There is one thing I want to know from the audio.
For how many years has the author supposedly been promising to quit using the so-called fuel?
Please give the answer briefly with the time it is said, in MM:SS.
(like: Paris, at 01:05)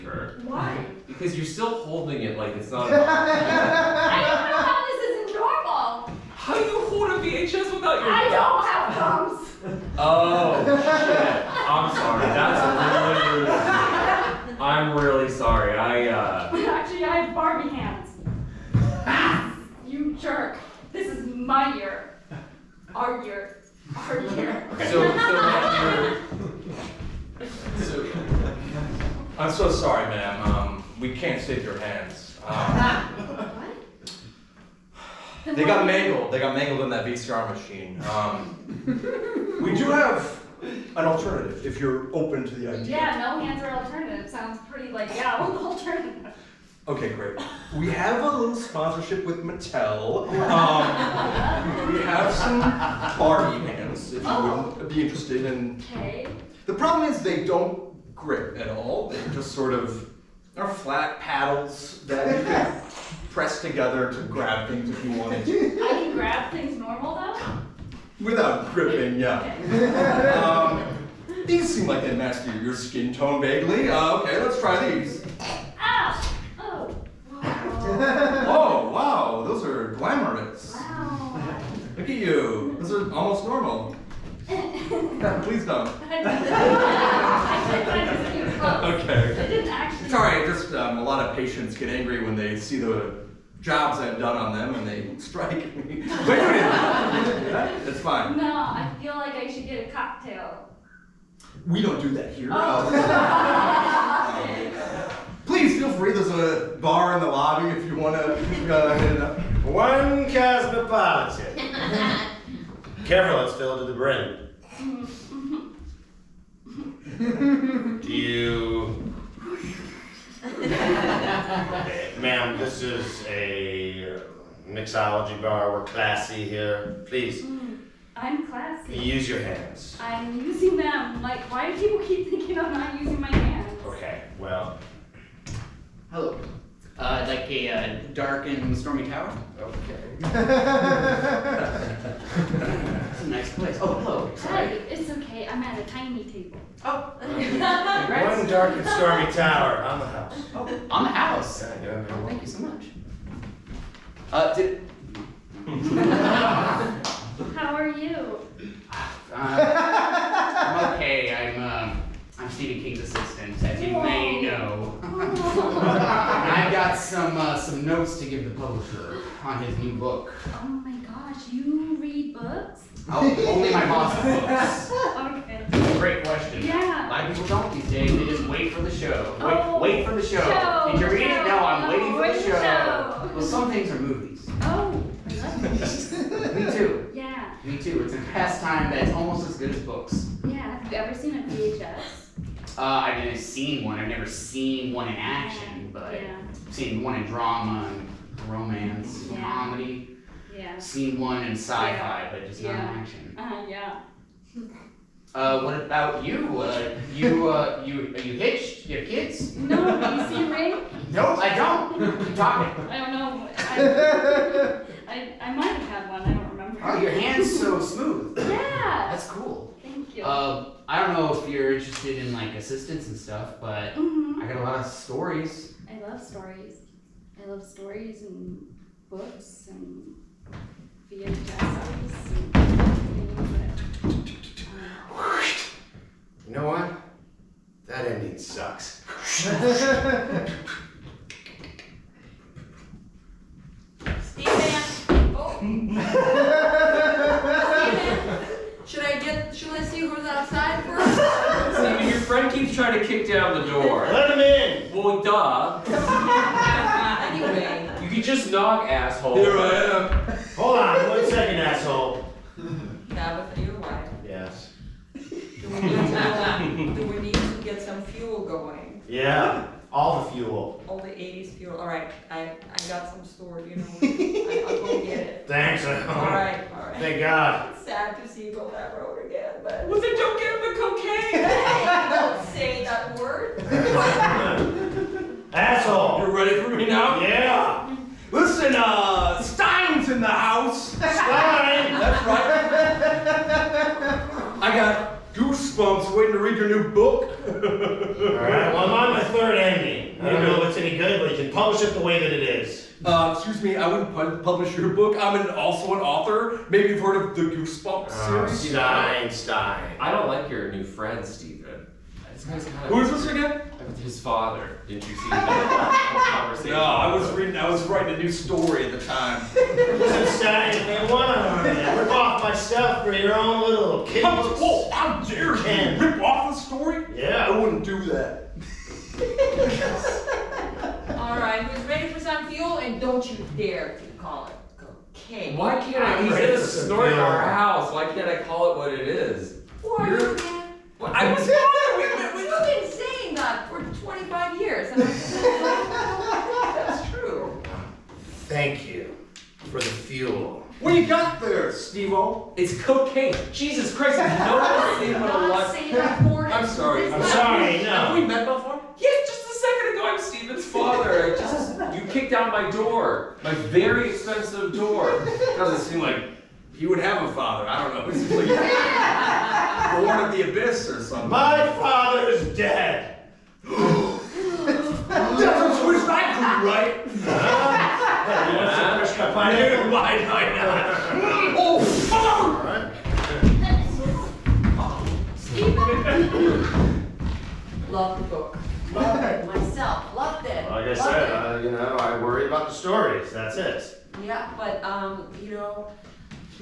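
25, at 05:44.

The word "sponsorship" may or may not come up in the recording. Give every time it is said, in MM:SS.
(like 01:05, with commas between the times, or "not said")
00:48.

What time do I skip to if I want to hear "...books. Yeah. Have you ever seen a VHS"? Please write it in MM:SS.
03:09.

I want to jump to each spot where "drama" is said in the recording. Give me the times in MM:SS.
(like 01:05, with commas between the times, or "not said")
03:17.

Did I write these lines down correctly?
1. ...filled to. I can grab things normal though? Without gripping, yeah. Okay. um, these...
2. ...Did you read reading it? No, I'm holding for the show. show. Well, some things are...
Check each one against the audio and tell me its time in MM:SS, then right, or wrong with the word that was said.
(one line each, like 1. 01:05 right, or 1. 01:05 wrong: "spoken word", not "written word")
1. 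01:05 wrong: "wanted", not "filled"
2. 03:00 wrong: "waiting", not "holding".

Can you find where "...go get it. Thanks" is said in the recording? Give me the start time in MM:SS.
04:34.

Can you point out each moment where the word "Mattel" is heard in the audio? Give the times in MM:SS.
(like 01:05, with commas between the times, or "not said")
00:49.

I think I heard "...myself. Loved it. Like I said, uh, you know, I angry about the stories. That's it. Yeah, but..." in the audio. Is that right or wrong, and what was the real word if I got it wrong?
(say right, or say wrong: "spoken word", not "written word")
wrong: "worry", not "angry".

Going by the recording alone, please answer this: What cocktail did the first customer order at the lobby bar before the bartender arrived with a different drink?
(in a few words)
cosmopolitan.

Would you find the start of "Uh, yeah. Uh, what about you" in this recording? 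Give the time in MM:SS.
03:23.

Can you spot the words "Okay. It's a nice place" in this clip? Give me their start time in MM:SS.
02:19.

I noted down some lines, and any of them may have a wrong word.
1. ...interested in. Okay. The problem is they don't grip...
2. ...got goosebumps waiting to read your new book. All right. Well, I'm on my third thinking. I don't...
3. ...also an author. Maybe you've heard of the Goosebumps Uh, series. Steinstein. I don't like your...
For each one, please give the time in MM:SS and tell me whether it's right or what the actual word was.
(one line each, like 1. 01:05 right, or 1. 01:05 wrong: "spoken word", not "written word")
1. 00:55 right
2. 04:54 wrong: "ending", not "thinking"
3. 05:05 right.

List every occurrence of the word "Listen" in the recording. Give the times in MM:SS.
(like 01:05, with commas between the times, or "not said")
04:48, 05:19.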